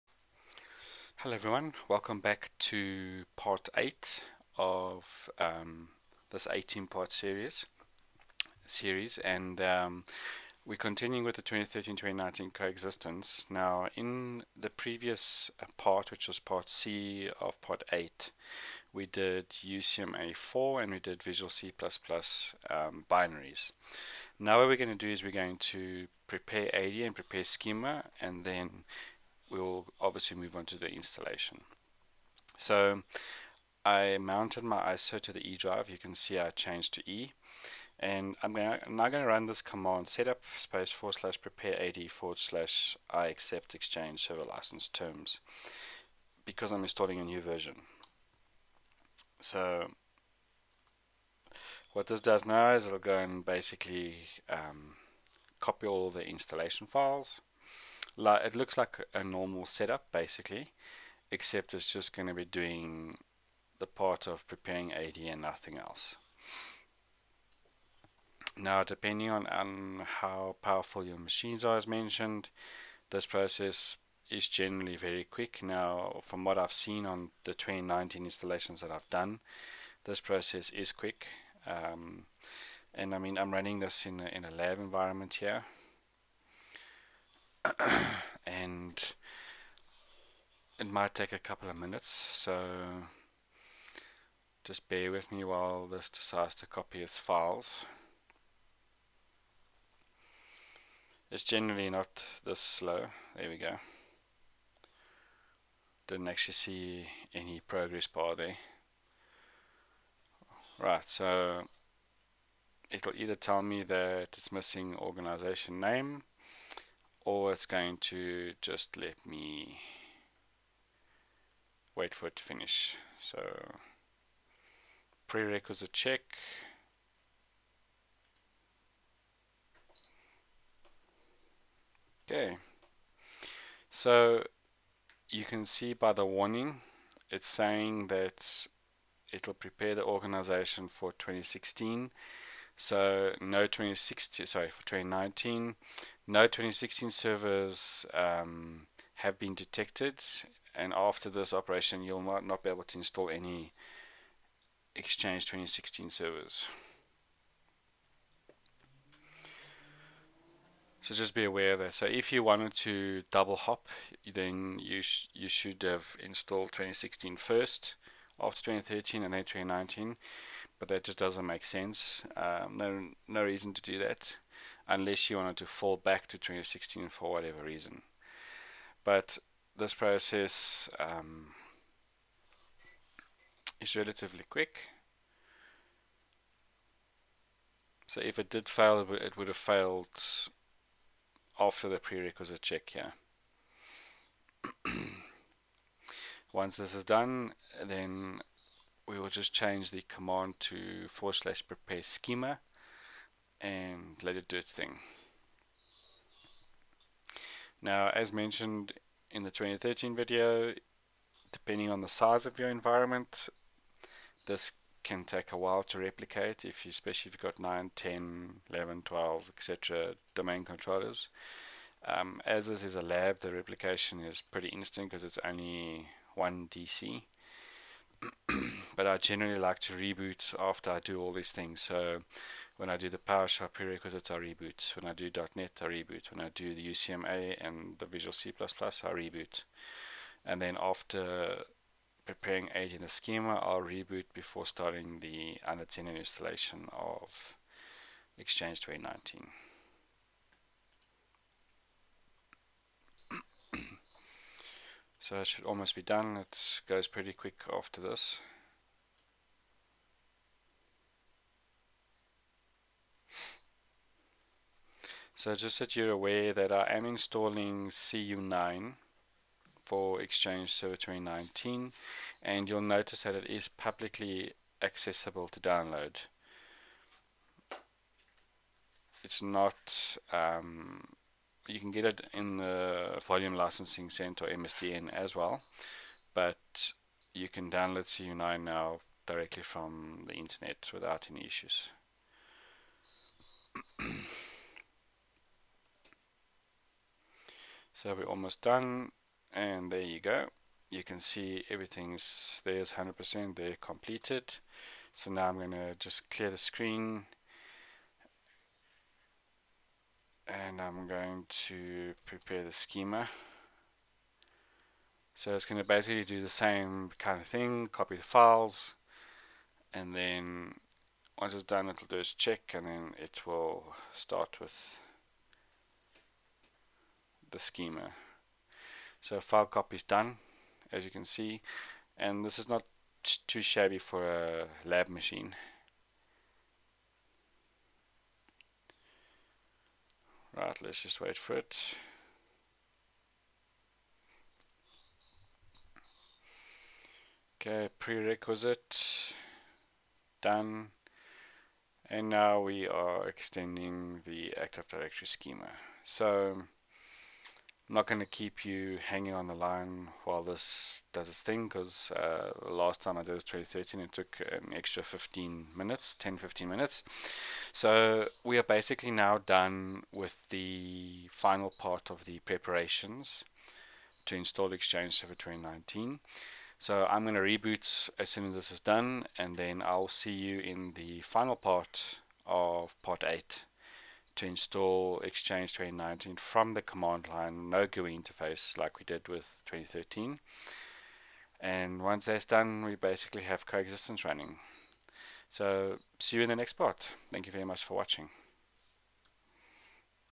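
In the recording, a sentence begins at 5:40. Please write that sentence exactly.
Right, let's just wait for it.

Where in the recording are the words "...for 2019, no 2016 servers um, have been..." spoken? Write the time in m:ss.
2:24.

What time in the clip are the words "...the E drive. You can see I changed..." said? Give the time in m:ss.
0:35.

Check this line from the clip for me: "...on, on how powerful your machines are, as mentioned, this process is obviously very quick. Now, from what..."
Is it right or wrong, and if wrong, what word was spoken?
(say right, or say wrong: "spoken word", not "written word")
wrong: "generally", not "obviously".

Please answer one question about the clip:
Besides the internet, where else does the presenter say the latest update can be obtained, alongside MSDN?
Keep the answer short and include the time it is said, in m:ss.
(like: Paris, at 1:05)
Volume Licensing Center, at 4:43.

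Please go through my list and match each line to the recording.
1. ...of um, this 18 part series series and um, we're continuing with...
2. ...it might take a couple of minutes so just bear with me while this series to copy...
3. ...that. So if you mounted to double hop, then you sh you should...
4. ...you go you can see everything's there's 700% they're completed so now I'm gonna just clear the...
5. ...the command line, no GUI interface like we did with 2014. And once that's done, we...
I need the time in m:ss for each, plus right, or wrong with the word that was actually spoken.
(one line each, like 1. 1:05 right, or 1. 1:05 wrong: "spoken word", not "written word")
1. 0:04 right
2. 1:30 wrong: "decides", not "series"
3. 2:41 wrong: "wanted", not "mounted"
4. 5:00 wrong: "100", not "700"
5. 6:26 wrong: "2013", not "2014".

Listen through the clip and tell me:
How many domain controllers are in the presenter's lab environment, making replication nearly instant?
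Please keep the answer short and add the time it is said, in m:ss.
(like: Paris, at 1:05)
1, at 3:45.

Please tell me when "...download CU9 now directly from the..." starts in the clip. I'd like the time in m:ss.
4:47.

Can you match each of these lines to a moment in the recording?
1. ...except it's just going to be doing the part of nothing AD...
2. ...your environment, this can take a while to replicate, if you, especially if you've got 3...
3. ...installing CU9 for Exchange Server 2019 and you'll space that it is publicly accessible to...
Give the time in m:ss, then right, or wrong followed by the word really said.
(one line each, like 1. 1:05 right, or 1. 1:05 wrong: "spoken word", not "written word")
1. 1:01 wrong: "preparing", not "nothing"
2. 3:32 wrong: "9", not "3"
3. 4:27 wrong: "notice", not "space".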